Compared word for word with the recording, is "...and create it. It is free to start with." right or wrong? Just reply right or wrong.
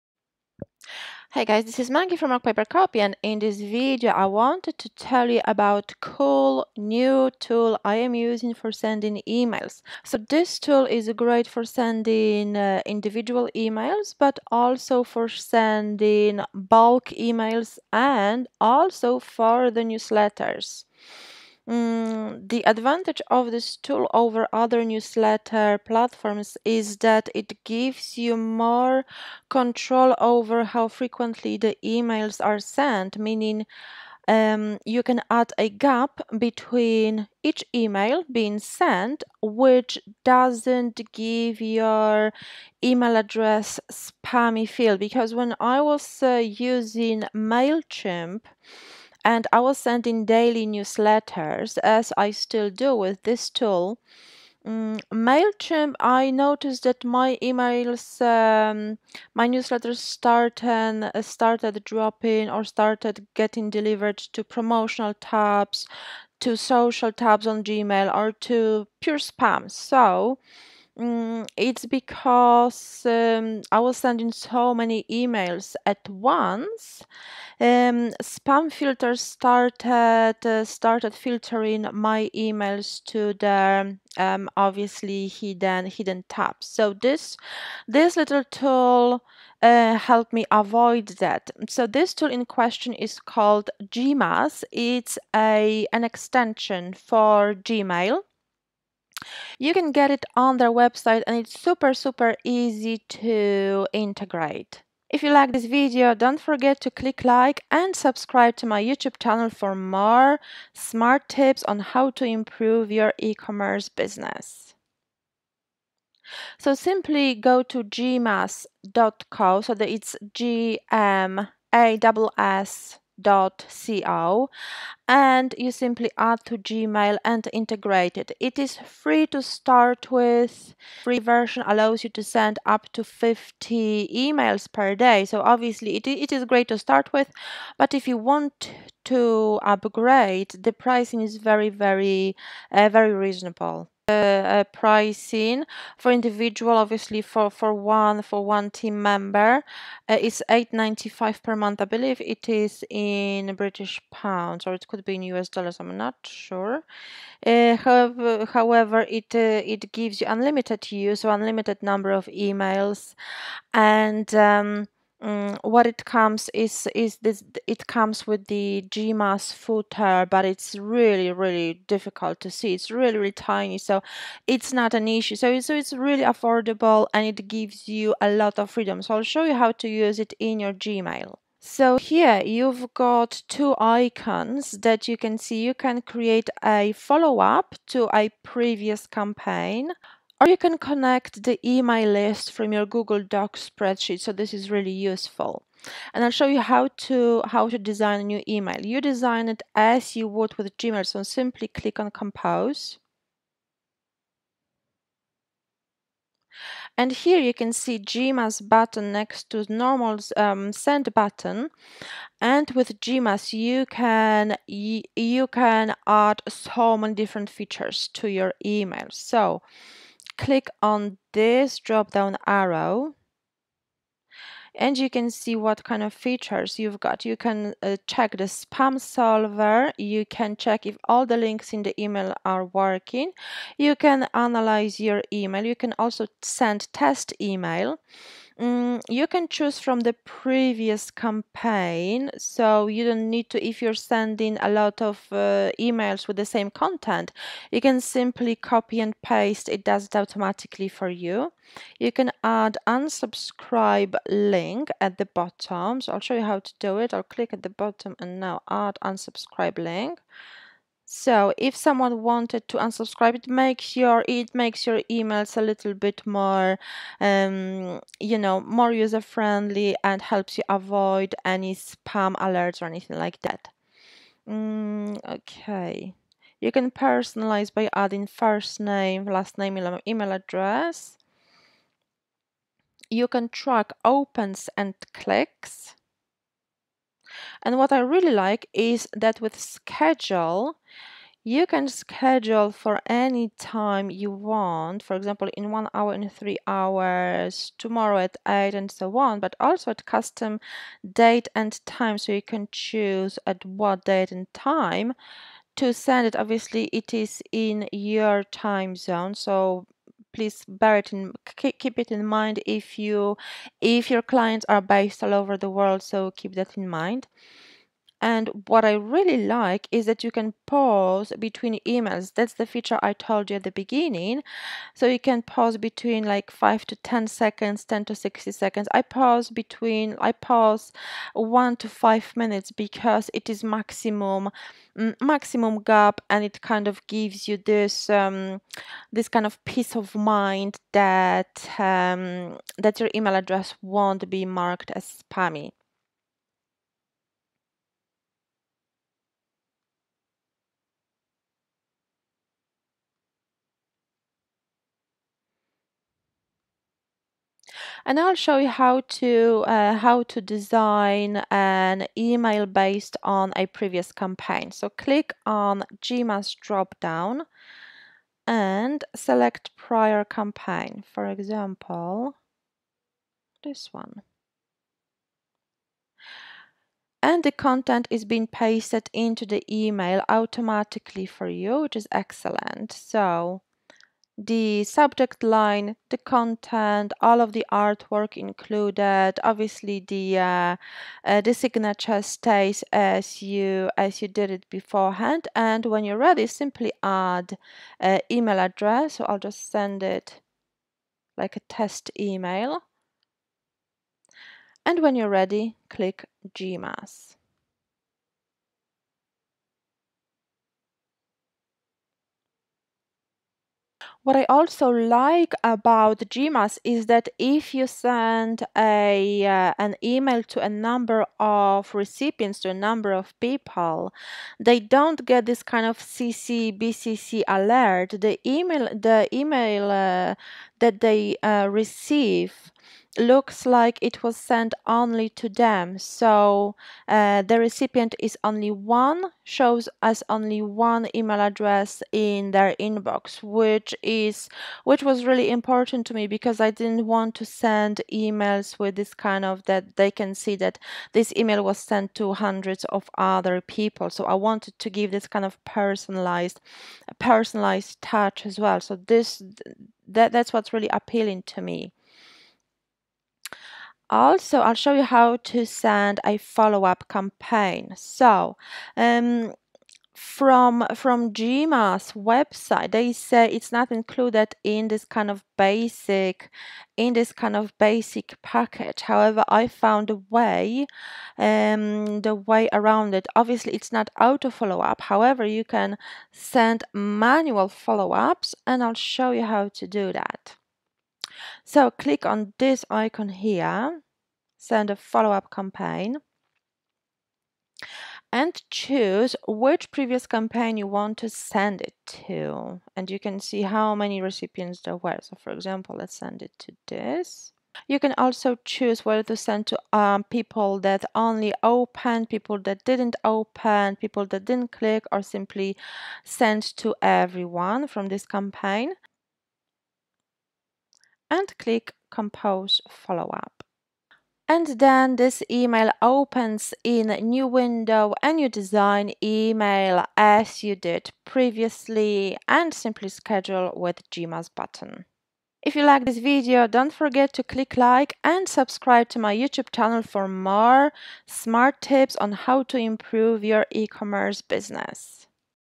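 wrong.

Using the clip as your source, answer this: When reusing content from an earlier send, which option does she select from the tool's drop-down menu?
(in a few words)
Prior campaign.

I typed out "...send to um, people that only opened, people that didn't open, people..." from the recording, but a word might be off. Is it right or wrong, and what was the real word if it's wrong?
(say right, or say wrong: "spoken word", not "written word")
right.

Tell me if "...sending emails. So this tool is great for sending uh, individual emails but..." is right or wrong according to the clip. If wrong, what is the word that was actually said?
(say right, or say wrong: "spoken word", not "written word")
right.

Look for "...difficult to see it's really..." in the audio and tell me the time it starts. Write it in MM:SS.
02:51.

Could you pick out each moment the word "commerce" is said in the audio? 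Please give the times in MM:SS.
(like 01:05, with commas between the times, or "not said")
01:53, 09:03.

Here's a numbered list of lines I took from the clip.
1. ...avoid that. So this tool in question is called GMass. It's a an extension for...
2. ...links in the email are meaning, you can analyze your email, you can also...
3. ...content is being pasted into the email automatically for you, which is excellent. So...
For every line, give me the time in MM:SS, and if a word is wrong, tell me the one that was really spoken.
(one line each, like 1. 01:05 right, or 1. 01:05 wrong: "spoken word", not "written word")
1. 01:30 right
2. 03:51 wrong: "working", not "meaning"
3. 06:17 right.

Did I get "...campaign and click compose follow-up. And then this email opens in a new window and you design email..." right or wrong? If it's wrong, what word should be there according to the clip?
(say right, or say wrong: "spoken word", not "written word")
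right.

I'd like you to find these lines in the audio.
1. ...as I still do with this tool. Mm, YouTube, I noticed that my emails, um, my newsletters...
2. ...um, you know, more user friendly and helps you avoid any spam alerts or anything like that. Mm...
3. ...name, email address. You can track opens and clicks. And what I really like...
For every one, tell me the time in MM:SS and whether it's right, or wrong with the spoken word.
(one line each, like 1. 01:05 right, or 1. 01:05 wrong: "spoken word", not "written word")
1. 00:51 wrong: "Mailchimp", not "YouTube"
2. 04:27 right
3. 04:39 right.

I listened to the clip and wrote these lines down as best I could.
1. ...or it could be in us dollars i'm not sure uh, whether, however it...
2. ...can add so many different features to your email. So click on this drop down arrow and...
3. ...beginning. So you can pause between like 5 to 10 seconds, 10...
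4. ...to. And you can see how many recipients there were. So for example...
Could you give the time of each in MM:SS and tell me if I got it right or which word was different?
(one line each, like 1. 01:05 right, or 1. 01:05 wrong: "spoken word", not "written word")
1. 02:34 wrong: "however", not "whether"
2. 03:35 right
3. 05:23 right
4. 08:22 right.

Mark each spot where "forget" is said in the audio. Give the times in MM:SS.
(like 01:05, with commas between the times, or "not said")
01:46, 08:56.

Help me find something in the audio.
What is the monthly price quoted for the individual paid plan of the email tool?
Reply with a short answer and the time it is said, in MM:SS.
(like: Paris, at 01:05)
8.95, at 02:30.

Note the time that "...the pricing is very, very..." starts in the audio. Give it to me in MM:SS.
02:20.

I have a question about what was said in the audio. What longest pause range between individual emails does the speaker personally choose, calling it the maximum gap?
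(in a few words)
1 to 5 minutes.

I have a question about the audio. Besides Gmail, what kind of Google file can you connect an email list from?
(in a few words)
Spreadsheet.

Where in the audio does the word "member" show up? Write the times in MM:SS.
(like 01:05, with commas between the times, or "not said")
02:29.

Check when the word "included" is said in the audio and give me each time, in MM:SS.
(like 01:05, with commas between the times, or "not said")
06:28, 07:53.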